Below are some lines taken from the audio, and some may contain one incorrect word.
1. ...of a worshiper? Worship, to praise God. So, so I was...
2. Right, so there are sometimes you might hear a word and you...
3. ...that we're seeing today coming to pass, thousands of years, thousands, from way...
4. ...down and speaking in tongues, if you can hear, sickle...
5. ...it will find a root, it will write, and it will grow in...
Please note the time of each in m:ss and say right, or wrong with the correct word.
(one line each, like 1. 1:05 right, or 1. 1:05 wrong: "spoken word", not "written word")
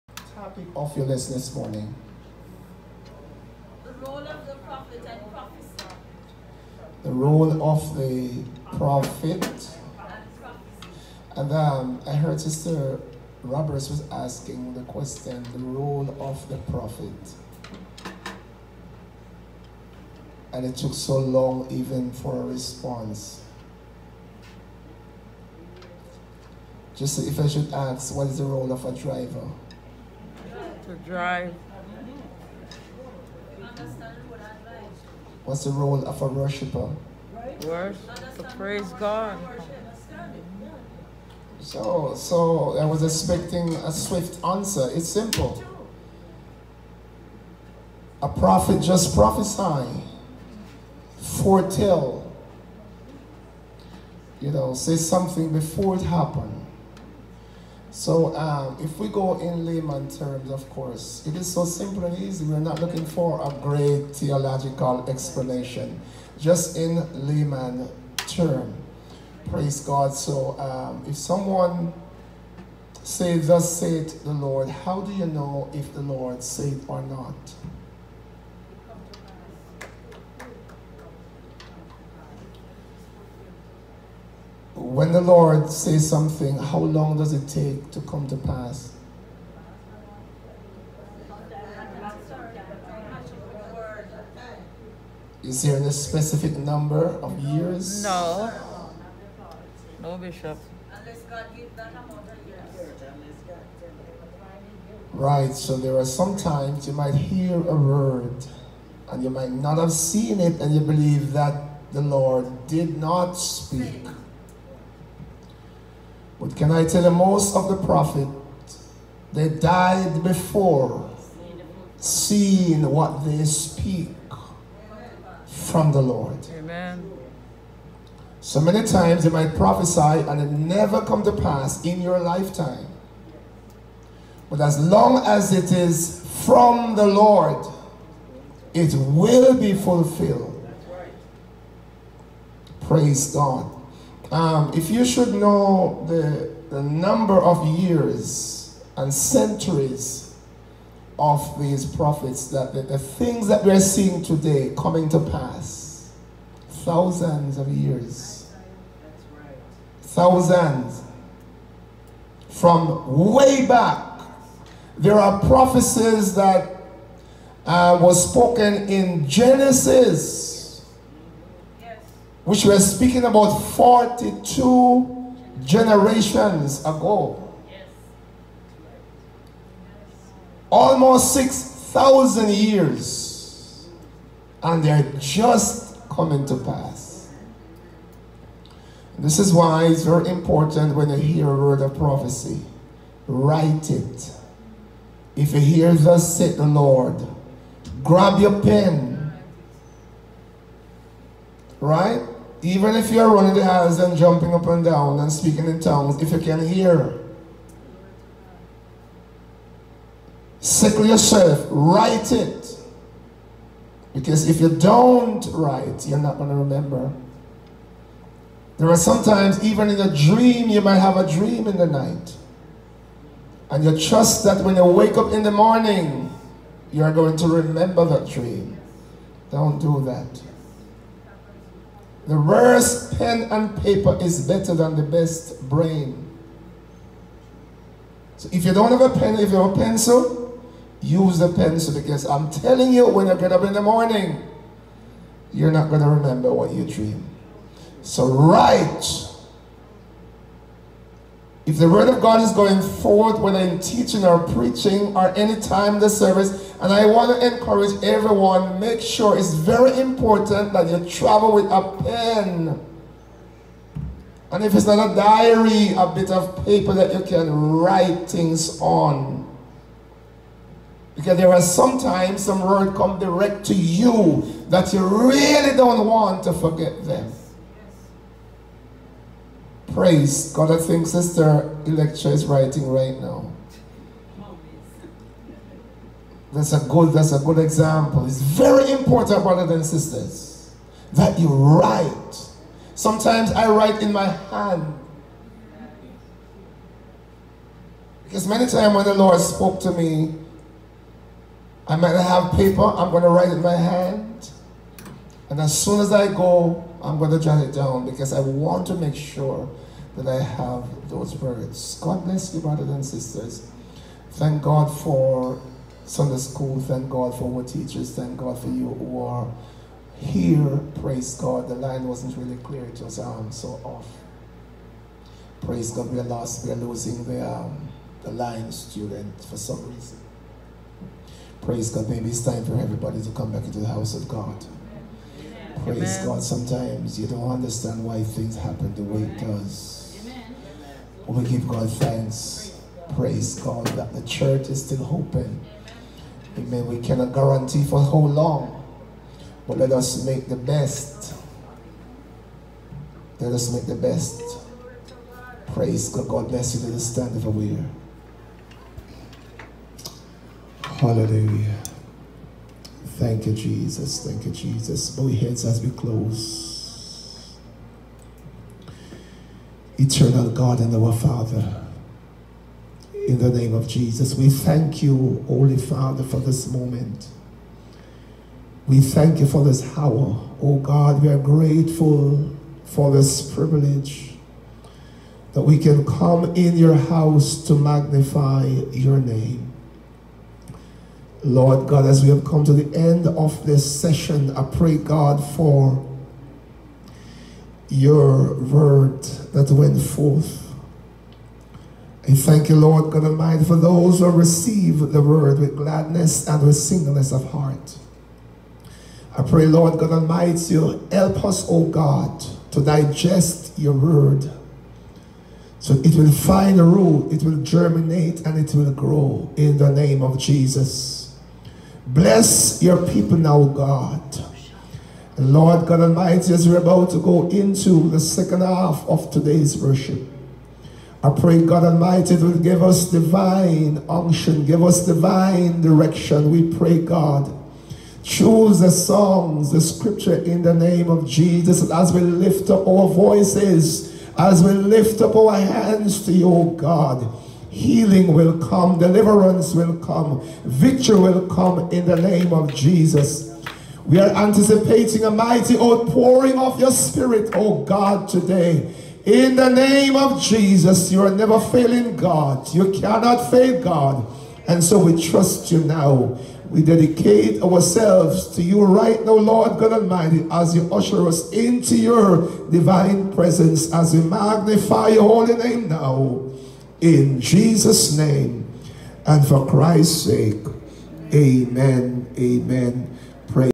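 1. 0:36 right
2. 1:45 right
3. 2:33 right
4. 3:24 right
5. 6:56 wrong: "germinate", not "write".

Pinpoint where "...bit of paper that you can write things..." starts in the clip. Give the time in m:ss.
4:26.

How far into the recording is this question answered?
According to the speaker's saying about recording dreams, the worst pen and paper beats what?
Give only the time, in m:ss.
3:54.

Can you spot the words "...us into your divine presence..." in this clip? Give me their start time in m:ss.
7:51.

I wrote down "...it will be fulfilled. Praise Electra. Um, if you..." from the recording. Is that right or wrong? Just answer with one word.
wrong.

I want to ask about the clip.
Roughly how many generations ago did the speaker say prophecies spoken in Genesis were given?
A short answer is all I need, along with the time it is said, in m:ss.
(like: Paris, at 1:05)
42, at 2:53.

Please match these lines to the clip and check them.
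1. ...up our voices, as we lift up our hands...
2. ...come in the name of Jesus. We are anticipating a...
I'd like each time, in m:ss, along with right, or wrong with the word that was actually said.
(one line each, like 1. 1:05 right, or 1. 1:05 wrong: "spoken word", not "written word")
1. 7:22 right
2. 7:31 right.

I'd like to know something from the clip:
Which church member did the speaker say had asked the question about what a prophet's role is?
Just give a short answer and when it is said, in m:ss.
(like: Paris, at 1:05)
Sister Roberts, at 0:12.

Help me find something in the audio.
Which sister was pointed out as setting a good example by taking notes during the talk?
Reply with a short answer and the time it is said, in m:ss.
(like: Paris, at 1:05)
Sister Electra, at 4:41.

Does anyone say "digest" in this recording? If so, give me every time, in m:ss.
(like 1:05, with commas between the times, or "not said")
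6:52.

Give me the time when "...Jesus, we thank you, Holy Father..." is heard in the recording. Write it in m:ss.
6:13.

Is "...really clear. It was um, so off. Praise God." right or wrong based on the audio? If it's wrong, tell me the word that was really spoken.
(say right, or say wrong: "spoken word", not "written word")
right.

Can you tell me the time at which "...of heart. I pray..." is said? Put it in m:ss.
6:47.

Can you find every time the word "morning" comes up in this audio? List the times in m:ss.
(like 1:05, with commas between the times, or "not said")
0:01, 3:45, 4:03.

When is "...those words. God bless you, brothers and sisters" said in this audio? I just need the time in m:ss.
5:11.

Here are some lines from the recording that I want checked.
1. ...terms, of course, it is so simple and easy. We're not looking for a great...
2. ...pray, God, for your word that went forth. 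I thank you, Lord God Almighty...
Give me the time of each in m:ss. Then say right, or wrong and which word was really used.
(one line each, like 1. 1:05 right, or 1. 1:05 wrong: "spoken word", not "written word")
1. 1:00 right
2. 6:34 right.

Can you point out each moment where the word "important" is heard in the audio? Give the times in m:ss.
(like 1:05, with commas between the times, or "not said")
3:10, 4:19, 4:48.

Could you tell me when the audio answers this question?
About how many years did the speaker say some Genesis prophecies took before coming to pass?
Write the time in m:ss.
3:01.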